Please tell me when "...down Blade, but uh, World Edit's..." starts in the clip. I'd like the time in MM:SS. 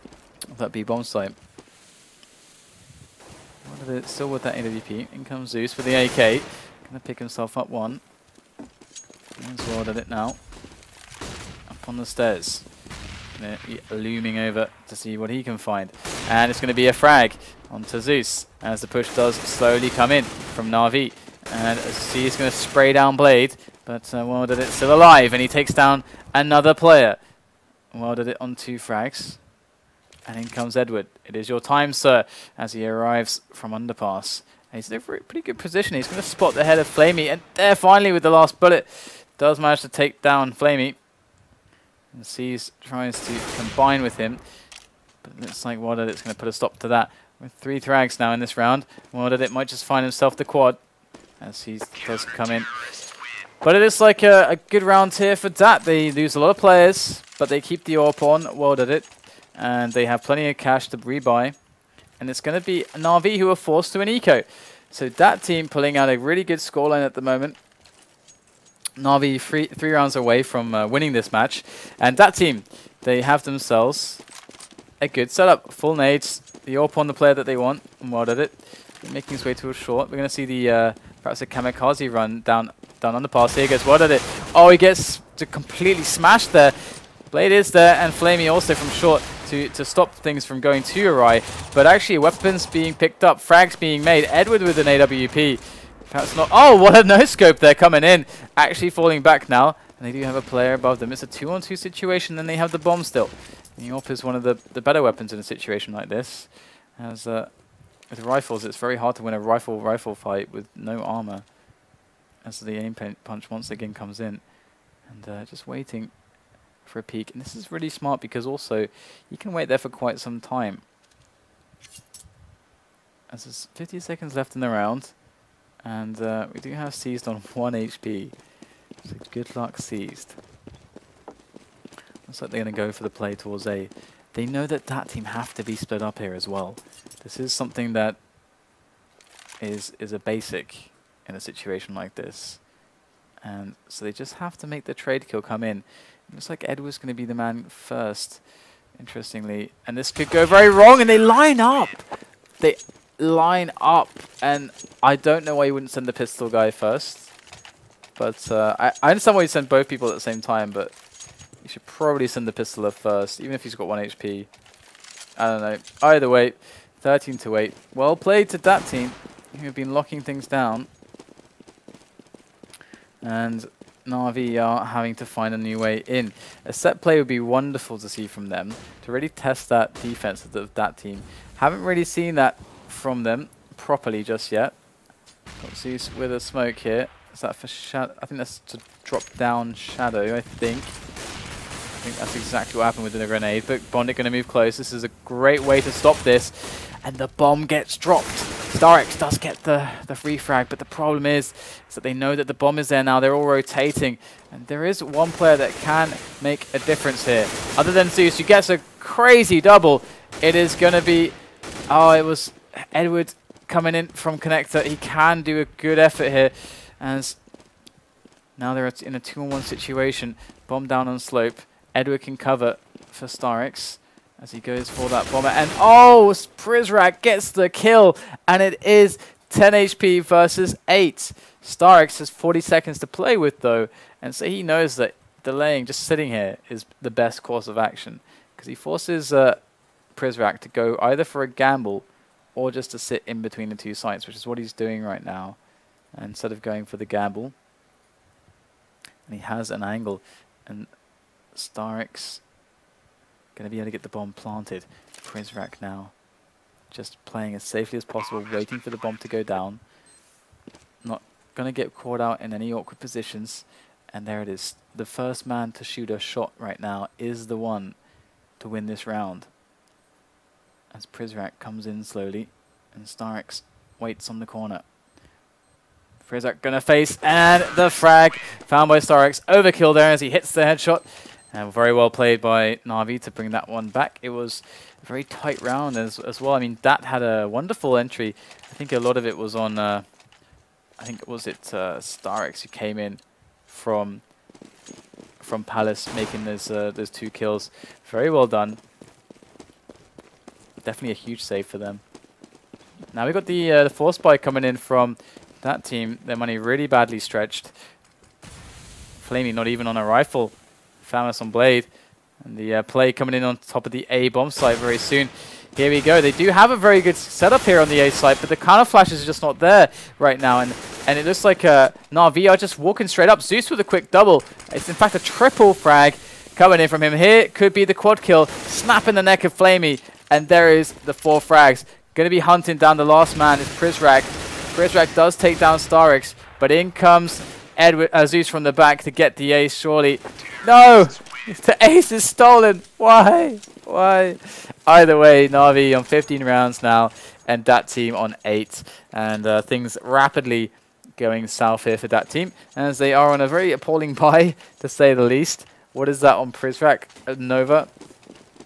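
00:22.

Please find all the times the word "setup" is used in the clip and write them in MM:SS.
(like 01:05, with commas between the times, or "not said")
01:15, 05:17.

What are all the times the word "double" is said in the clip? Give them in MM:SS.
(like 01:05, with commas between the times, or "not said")
03:29, 05:24.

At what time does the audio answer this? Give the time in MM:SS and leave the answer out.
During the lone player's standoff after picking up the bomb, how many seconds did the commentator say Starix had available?
03:52.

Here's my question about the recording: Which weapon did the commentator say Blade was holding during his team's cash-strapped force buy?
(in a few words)
FAMAS.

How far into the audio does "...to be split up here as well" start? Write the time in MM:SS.
02:15.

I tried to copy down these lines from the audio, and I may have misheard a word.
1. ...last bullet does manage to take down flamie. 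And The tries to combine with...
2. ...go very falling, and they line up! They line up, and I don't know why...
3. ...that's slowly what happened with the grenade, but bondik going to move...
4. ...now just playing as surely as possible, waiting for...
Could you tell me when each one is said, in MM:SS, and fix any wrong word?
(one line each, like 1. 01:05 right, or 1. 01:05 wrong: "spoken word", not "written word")
1. 00:38 wrong: "Seas", not "The"
2. 02:30 wrong: "wrong", not "falling"
3. 03:12 wrong: "exactly", not "slowly"
4. 04:15 wrong: "safely", not "surely".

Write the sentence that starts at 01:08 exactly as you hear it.
Na'Vi three, three rounds away from uh, winning this match.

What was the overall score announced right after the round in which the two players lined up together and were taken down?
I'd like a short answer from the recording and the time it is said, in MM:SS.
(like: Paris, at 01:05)
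13 to 8, at 02:46.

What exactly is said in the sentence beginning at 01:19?
Making his way to a short.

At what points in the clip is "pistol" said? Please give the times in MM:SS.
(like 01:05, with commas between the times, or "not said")
02:36, 02:42.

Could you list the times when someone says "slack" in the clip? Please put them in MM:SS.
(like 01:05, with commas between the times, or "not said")
not said.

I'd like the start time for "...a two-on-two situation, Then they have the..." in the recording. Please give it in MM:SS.
01:41.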